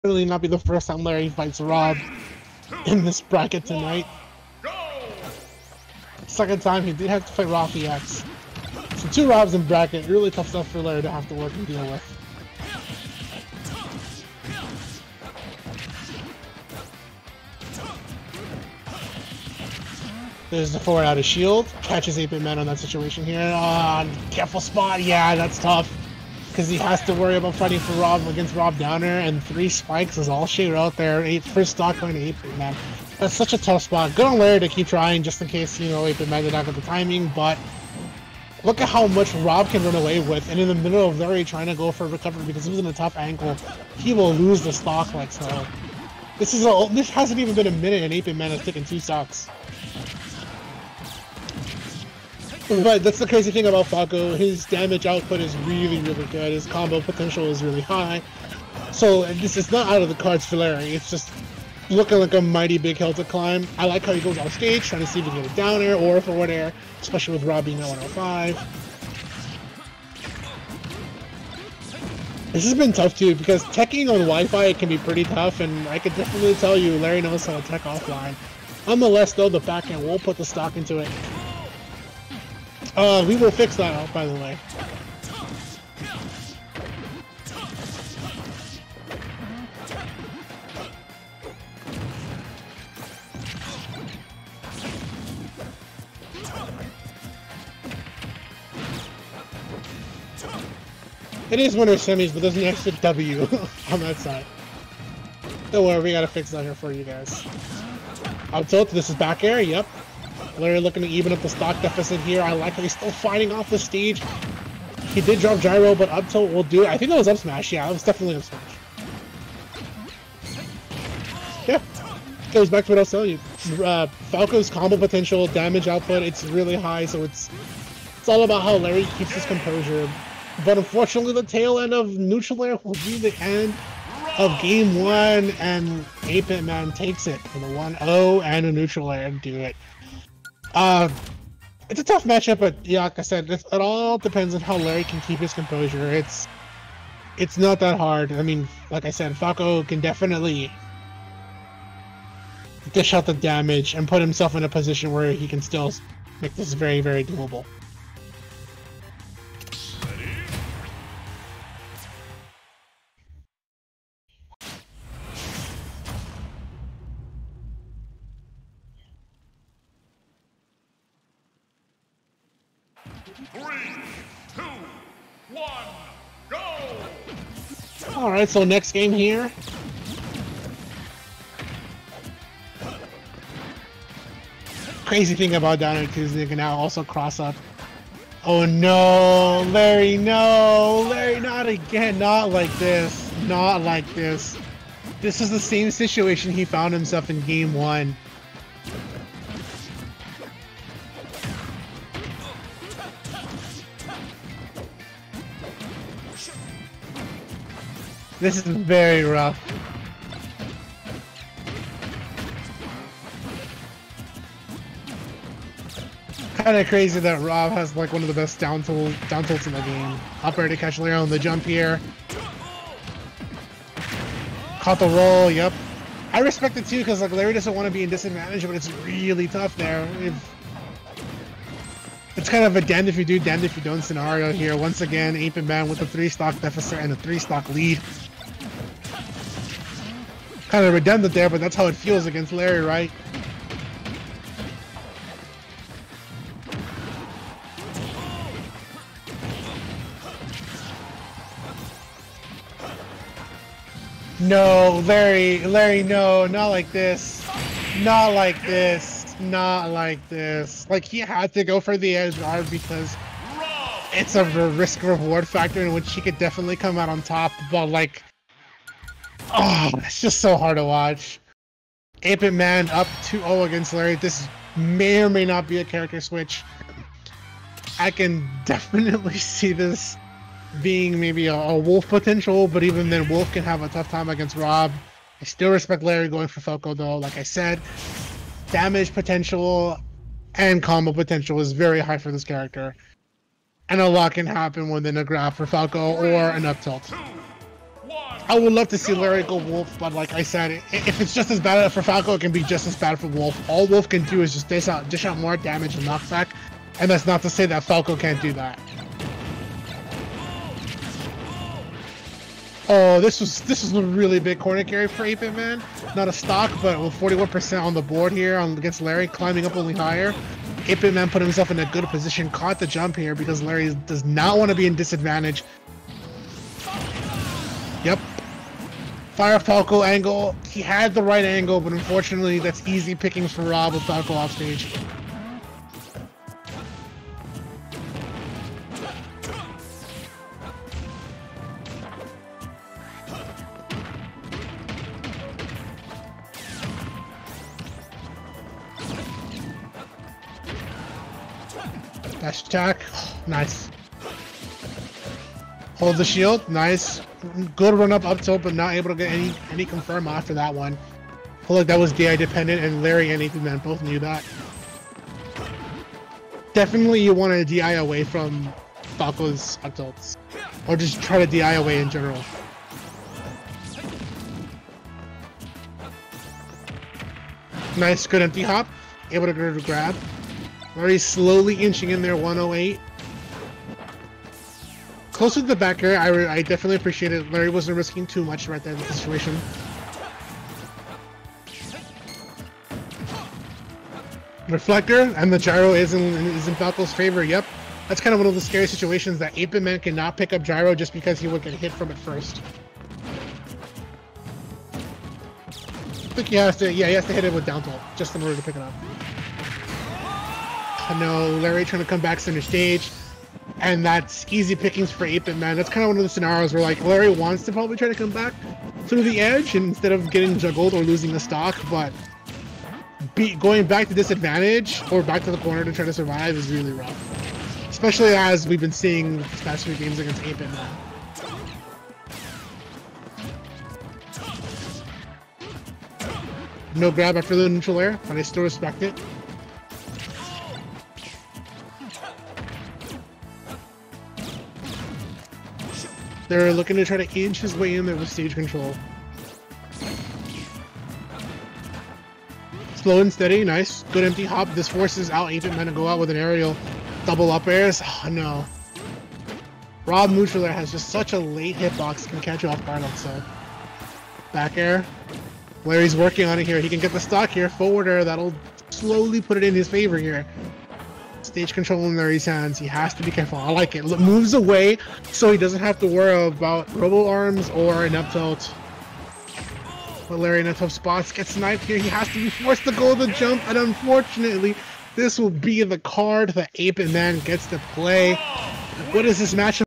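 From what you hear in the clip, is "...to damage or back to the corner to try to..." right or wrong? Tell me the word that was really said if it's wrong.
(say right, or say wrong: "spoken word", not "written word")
wrong: "disadvantage", not "damage".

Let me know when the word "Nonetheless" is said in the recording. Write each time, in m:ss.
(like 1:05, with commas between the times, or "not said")
1:18.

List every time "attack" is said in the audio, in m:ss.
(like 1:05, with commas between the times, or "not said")
5:52.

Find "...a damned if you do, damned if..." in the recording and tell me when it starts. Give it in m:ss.
3:52.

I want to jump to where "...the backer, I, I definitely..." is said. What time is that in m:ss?
6:25.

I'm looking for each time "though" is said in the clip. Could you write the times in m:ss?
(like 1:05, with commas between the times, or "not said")
1:19, 4:46.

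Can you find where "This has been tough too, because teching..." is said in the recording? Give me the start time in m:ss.
1:12.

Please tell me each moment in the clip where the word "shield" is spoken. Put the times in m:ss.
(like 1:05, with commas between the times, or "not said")
0:21, 5:56.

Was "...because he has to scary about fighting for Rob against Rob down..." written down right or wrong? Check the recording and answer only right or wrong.
wrong.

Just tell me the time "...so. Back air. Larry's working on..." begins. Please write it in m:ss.
7:43.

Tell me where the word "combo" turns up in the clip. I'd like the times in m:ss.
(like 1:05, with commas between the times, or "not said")
0:56, 2:04, 4:50.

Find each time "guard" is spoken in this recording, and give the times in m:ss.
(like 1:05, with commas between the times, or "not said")
4:22, 7:42.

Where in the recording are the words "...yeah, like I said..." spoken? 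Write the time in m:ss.
2:22.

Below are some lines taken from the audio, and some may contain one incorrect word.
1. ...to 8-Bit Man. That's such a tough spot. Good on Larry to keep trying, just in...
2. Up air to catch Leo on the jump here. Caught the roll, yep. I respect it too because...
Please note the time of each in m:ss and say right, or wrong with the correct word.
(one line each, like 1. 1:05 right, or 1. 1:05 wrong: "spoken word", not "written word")
1. 0:32 right
2. 3:40 right.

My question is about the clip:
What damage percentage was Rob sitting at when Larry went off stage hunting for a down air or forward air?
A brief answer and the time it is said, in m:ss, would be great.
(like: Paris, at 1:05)
105, at 1:07.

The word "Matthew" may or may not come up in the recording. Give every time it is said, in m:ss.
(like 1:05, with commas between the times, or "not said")
not said.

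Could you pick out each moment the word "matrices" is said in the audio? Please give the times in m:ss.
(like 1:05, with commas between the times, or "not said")
not said.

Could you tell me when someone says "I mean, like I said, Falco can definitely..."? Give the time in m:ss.
2:28.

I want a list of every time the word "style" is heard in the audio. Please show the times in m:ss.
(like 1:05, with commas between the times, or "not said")
not said.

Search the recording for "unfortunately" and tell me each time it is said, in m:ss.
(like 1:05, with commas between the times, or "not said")
2:10, 5:31, 8:03.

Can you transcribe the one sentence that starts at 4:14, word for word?
No, Larry, Larry, no, not like this.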